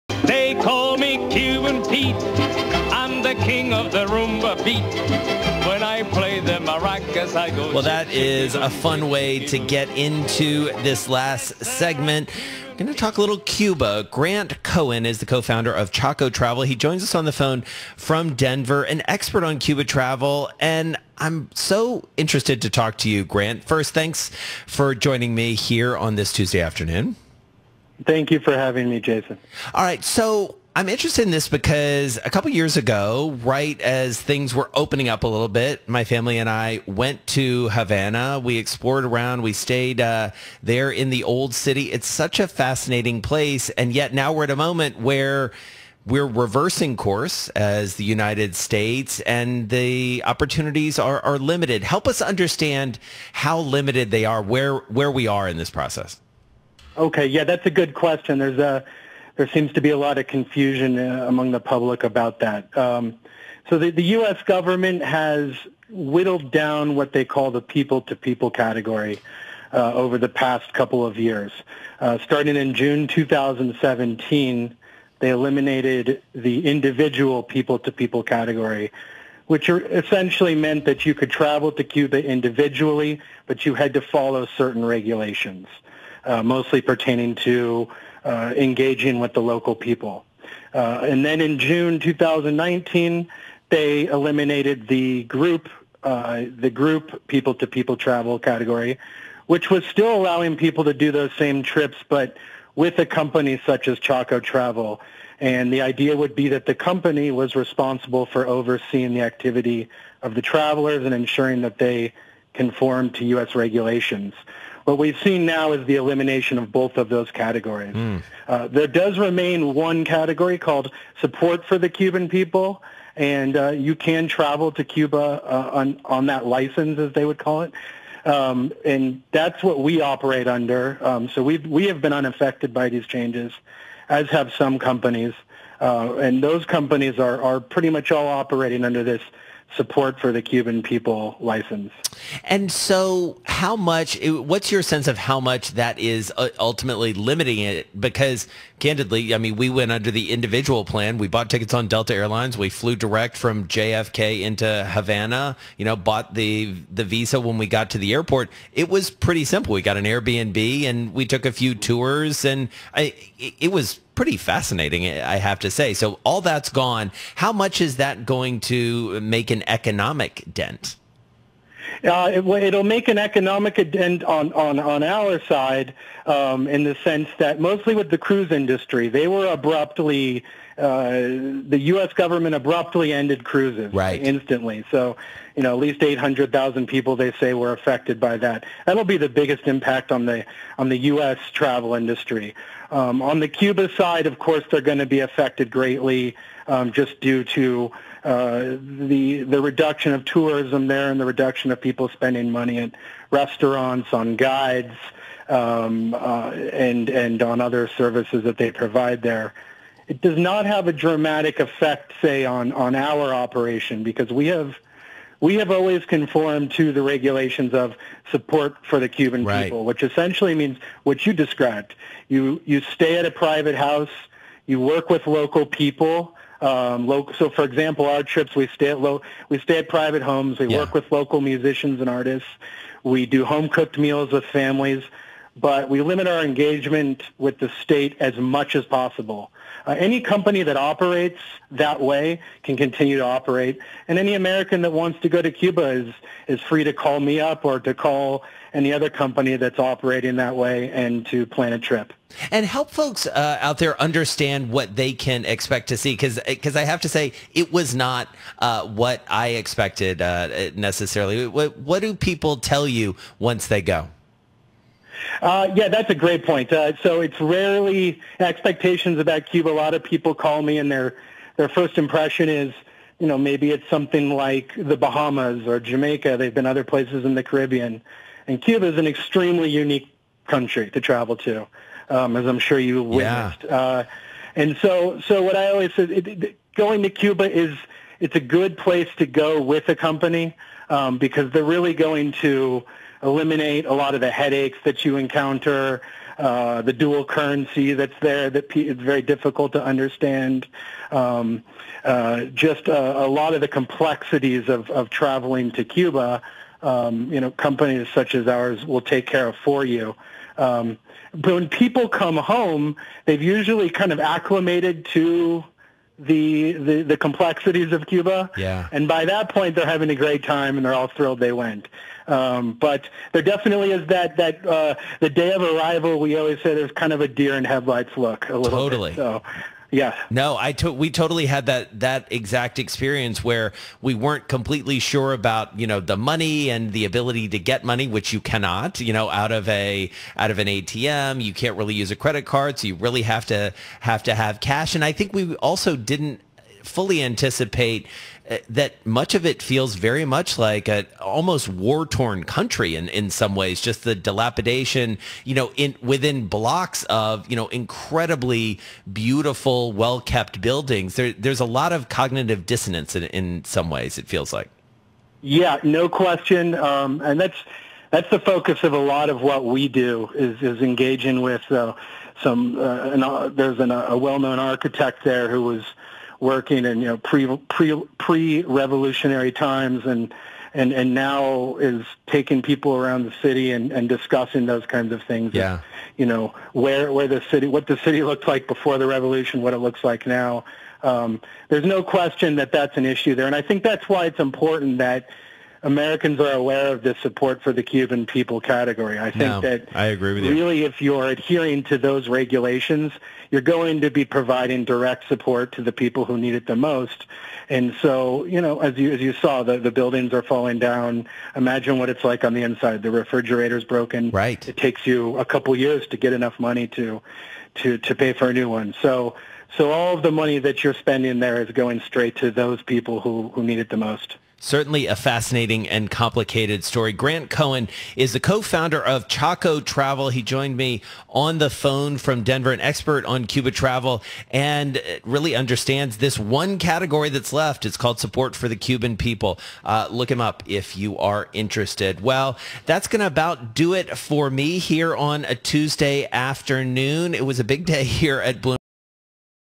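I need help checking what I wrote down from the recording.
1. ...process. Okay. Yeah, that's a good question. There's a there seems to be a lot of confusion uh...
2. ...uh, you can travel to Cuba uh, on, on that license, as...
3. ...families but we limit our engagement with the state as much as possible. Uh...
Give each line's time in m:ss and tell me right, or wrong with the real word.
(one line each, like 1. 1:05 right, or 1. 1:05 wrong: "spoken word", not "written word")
1. 0:55 right
2. 2:03 right
3. 3:54 right.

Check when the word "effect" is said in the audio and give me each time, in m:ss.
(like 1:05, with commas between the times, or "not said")
3:31.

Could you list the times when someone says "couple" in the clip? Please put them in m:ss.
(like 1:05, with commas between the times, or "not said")
0:32, 1:10, 6:55.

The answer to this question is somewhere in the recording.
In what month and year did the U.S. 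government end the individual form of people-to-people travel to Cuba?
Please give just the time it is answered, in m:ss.
1:12.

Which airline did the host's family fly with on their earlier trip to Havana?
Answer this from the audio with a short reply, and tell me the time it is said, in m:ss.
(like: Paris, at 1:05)
Delta Airlines, at 2:31.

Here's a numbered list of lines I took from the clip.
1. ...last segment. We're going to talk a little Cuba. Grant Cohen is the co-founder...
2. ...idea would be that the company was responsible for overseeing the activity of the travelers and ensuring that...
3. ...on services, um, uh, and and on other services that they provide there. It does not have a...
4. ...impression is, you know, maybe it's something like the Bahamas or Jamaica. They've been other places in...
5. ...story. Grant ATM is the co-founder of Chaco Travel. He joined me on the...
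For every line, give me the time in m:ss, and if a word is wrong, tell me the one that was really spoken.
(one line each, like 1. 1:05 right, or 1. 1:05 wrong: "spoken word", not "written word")
1. 0:11 right
2. 1:45 right
3. 3:24 wrong: "guides", not "services"
4. 4:31 right
5. 7:06 wrong: "Cohen", not "ATM".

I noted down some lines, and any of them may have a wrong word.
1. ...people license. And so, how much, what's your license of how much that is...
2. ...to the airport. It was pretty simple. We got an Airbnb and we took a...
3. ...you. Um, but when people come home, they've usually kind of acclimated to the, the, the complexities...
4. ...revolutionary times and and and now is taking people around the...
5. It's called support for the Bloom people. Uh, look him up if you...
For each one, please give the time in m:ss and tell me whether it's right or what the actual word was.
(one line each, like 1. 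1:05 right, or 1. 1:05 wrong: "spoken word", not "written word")
1. 2:20 wrong: "sense", not "license"
2. 2:37 right
3. 5:09 right
4. 6:18 right
5. 7:17 wrong: "Cuban", not "Bloom".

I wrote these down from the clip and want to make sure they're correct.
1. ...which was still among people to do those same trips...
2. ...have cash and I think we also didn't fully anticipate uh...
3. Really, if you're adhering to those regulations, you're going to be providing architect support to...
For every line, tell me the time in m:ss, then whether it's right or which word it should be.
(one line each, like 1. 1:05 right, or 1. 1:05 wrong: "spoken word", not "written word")
1. 1:39 wrong: "allowing", not "among"
2. 5:44 right
3. 6:40 wrong: "direct", not "architect".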